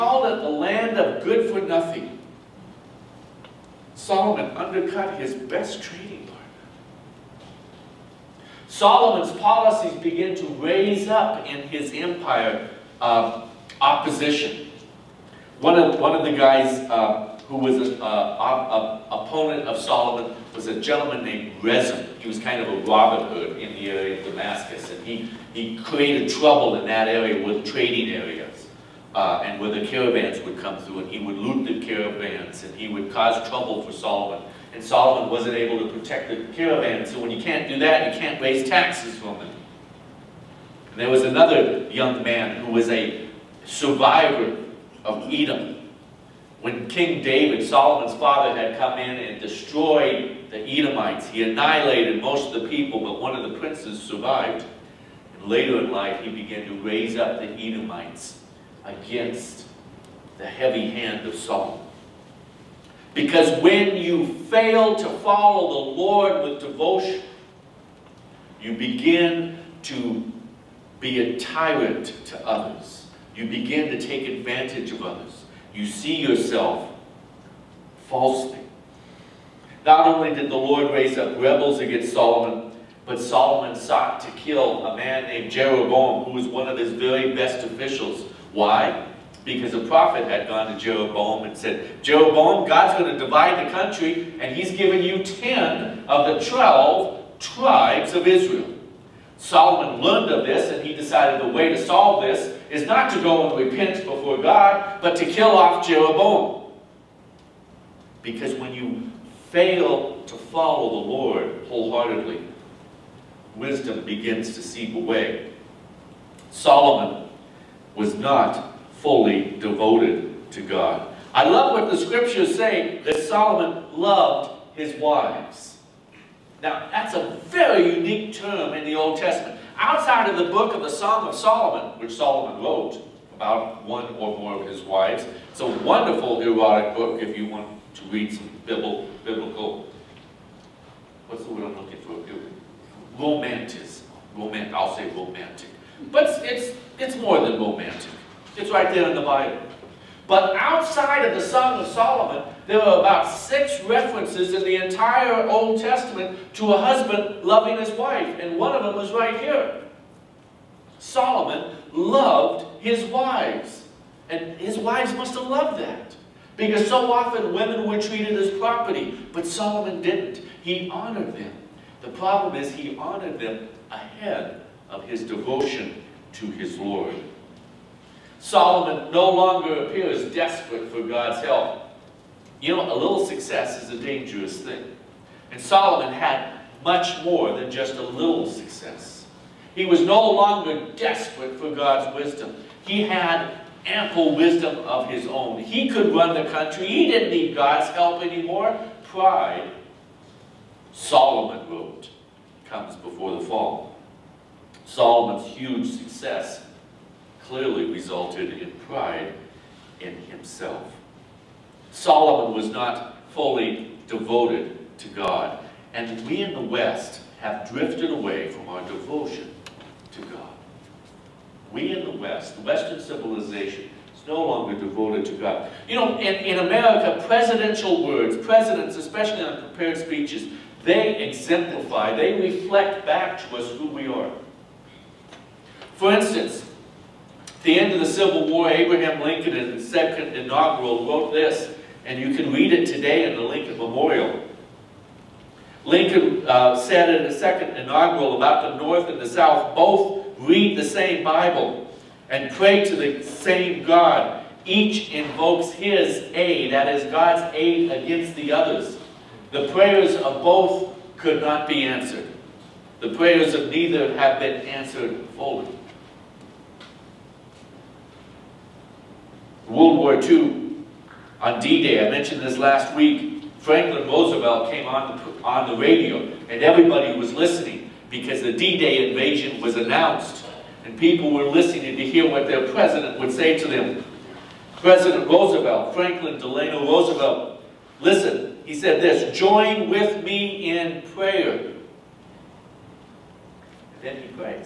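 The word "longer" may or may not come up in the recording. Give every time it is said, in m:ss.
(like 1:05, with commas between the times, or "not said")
2:59, 3:10, 3:44.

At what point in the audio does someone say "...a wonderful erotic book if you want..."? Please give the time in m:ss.
2:15.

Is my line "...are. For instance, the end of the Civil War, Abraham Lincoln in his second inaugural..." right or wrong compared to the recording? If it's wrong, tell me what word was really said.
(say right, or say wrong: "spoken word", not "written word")
right.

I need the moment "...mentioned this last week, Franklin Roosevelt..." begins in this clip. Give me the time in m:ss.
4:32.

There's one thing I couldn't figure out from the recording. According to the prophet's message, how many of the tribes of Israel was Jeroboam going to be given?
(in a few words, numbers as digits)
10.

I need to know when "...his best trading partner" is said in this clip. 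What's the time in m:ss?
0:05.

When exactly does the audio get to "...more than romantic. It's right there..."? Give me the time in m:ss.
2:27.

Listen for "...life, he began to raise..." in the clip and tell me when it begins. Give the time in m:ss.
0:55.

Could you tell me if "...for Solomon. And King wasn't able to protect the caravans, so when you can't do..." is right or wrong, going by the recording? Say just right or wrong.
wrong.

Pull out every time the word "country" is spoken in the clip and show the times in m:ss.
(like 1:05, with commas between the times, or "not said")
1:33, 3:16.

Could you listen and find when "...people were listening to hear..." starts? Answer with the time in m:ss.
4:40.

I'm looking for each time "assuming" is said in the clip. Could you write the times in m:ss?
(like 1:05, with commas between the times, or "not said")
not said.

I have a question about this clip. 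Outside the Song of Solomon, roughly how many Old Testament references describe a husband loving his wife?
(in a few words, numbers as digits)
6.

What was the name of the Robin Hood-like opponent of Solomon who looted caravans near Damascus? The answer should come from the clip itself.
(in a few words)
Rezin.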